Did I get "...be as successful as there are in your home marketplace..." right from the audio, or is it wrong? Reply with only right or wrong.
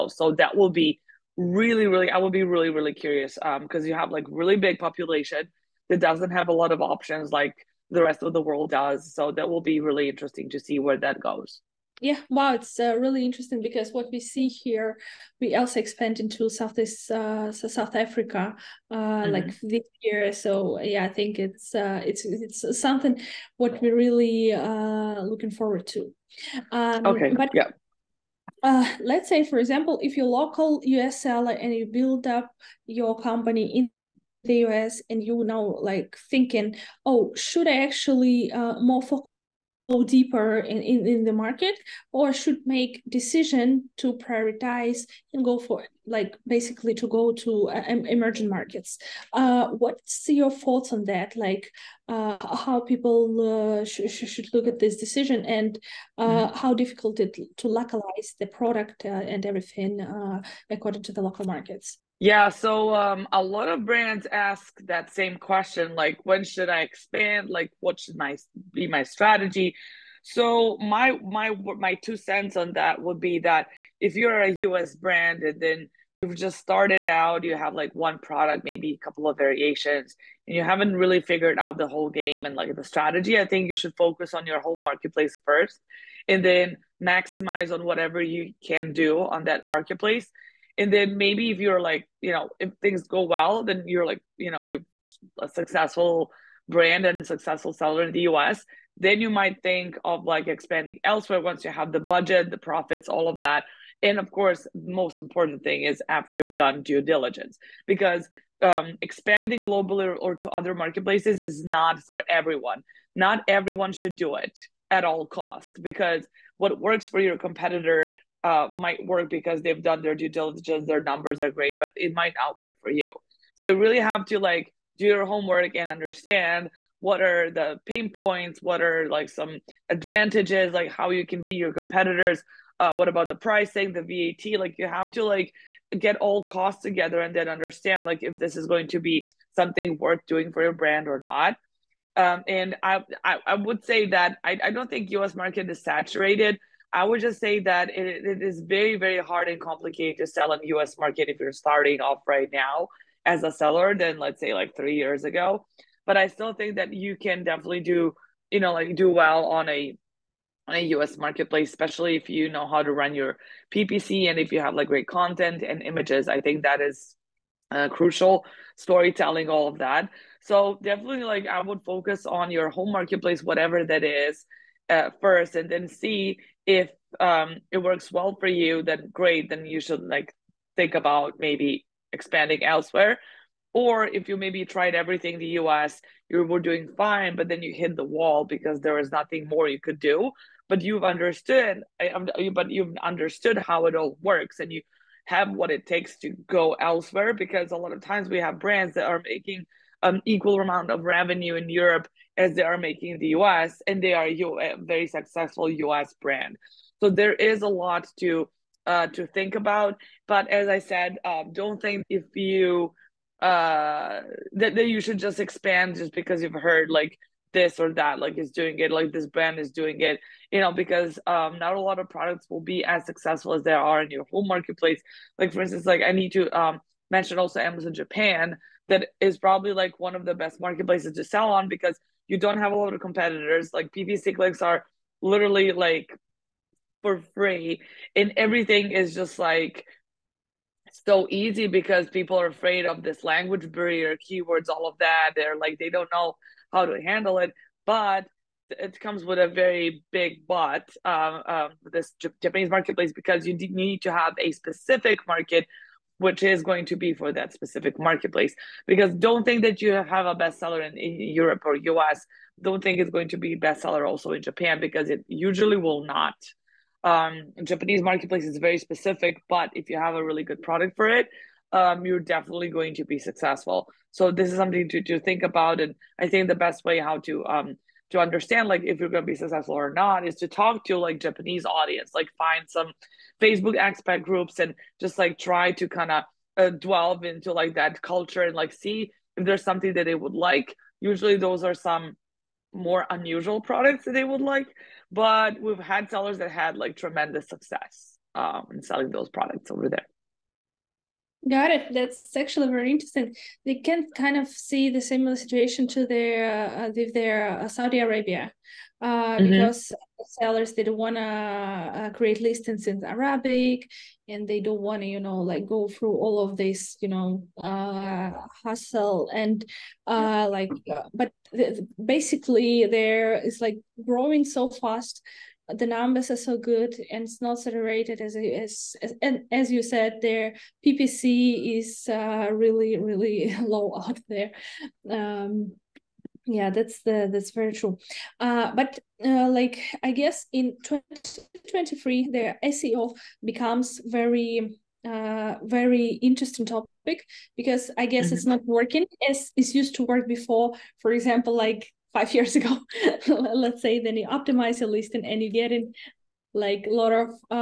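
right.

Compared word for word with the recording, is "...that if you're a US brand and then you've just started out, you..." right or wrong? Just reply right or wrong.
right.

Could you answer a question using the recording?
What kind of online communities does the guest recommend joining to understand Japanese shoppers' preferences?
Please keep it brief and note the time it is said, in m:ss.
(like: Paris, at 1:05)
Facebook expat groups, at 4:43.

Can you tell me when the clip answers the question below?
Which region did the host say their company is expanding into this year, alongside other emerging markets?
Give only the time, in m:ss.
0:17.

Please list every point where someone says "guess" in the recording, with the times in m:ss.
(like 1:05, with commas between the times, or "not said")
5:40, 5:48.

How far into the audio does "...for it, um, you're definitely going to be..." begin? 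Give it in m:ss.
4:30.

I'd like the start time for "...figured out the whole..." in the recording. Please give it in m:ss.
1:21.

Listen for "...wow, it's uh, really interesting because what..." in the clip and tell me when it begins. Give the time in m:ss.
0:12.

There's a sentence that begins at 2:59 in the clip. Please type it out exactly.
Then you should like think about maybe expanding elsewhere.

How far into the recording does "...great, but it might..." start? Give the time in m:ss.
2:01.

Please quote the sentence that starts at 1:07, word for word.
Like what should my be my strategy?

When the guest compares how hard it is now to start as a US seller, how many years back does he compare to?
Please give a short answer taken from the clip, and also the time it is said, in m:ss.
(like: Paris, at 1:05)
3, at 2:34.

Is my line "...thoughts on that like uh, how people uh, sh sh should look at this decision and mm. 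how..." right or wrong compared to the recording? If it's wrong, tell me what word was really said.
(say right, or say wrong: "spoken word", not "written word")
right.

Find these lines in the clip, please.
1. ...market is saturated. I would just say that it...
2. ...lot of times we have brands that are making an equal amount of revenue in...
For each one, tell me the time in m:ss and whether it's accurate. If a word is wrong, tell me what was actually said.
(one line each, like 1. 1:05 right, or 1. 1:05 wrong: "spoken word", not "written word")
1. 2:25 right
2. 3:17 right.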